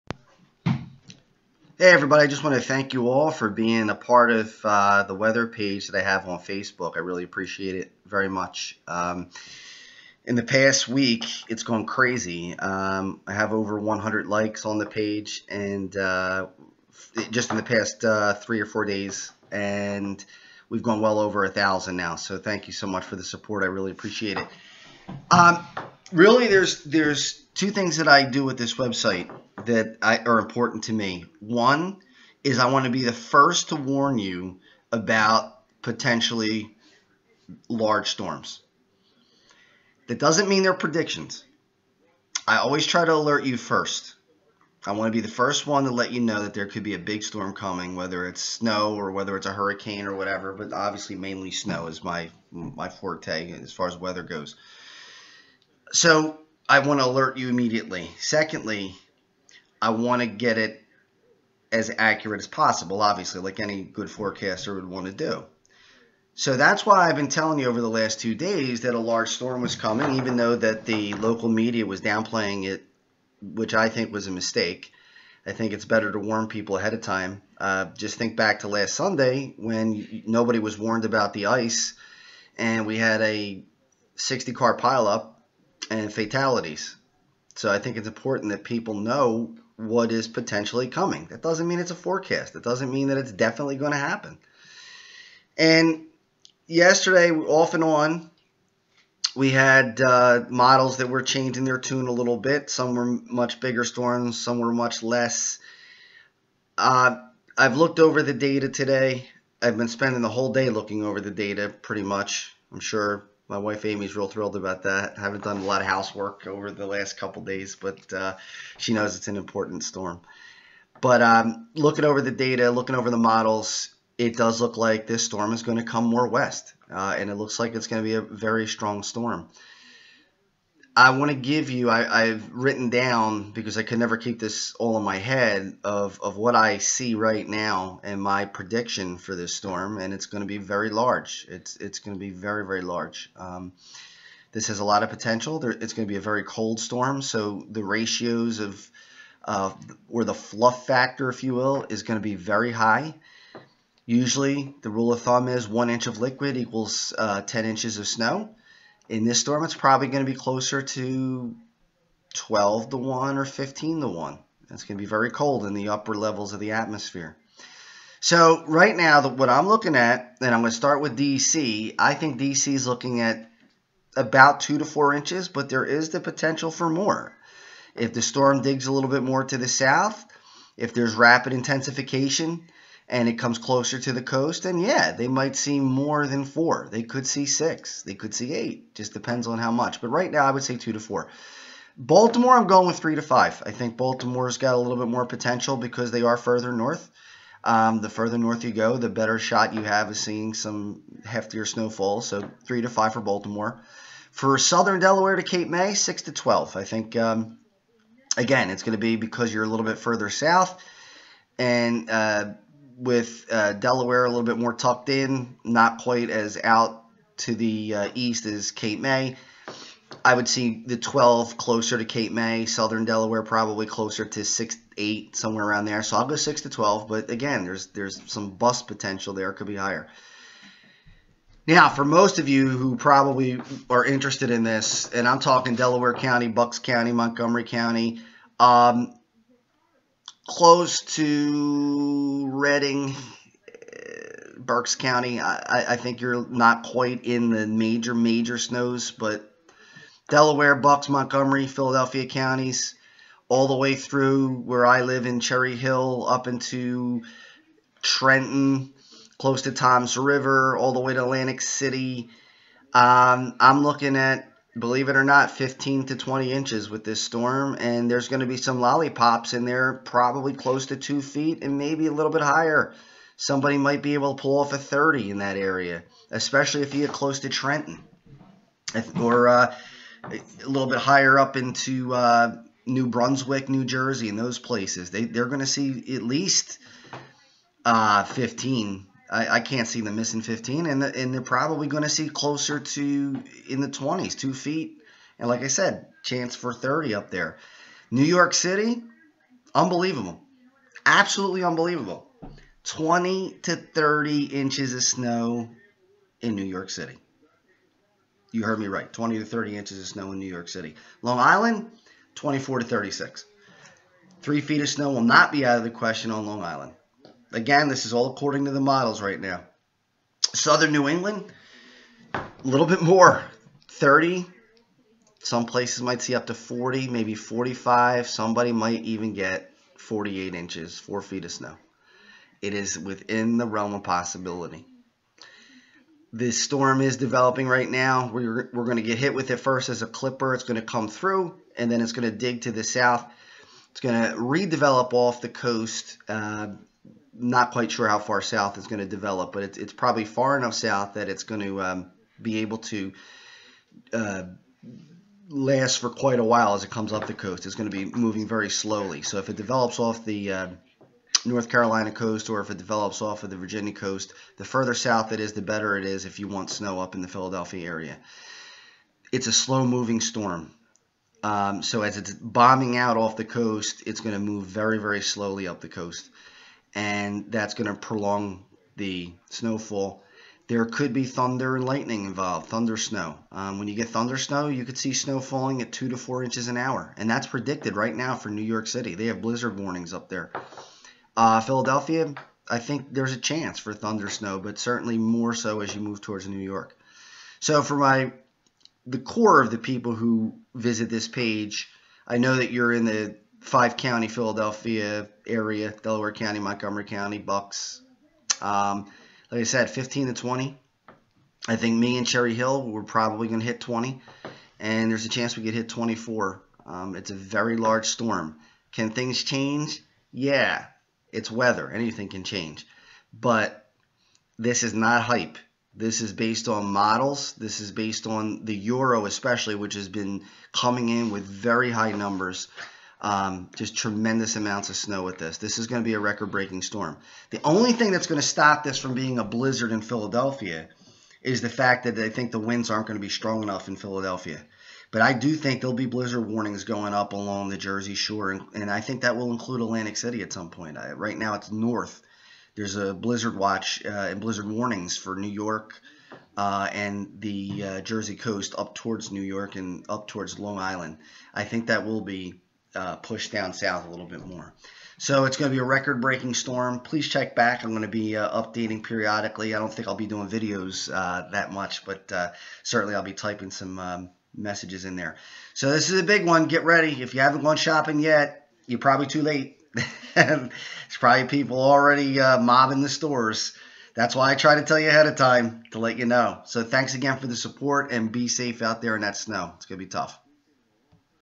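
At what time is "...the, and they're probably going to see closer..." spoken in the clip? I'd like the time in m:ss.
4:51.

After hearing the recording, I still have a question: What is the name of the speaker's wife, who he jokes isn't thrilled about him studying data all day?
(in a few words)
Amy.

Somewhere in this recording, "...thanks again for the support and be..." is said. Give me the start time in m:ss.
8:06.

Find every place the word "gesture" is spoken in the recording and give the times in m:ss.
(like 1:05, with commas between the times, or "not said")
not said.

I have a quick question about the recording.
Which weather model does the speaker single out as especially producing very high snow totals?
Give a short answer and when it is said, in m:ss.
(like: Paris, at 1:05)
The Euro, at 7:08.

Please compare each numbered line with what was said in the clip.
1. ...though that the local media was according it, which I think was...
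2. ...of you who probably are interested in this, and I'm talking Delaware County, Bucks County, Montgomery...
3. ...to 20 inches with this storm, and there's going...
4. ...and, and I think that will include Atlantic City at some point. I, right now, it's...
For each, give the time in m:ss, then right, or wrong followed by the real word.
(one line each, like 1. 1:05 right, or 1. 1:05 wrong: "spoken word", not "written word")
1. 1:10 wrong: "downplaying", not "according"
2. 3:52 right
3. 4:26 right
4. 7:28 right.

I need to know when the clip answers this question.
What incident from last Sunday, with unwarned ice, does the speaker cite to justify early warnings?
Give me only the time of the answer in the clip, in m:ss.
1:24.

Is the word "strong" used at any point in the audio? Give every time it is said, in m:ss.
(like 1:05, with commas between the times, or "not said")
2:08, 7:23.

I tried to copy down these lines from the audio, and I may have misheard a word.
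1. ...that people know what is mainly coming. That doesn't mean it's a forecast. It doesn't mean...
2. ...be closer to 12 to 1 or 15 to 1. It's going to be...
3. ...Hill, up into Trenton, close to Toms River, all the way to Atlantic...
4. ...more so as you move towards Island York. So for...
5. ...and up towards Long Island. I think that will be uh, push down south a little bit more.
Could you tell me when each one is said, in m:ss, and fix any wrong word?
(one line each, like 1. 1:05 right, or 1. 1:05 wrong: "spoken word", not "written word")
1. 1:28 wrong: "potentially", not "mainly"
2. 2:40 right
3. 4:15 right
4. 6:35 wrong: "New", not "Island"
5. 7:39 right.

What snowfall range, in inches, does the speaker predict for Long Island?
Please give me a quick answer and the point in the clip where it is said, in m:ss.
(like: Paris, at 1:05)
24 to 36, at 5:12.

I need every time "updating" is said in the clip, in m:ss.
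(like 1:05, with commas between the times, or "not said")
7:48.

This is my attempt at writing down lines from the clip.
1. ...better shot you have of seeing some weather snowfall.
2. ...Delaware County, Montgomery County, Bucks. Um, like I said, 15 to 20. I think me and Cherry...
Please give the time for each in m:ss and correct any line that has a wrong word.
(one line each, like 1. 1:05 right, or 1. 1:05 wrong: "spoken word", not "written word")
1. 3:19 wrong: "heftier", not "weather"
2. 6:46 right.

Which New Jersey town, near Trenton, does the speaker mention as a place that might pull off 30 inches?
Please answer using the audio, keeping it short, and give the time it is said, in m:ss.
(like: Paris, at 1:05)
New Brunswick, at 4:42.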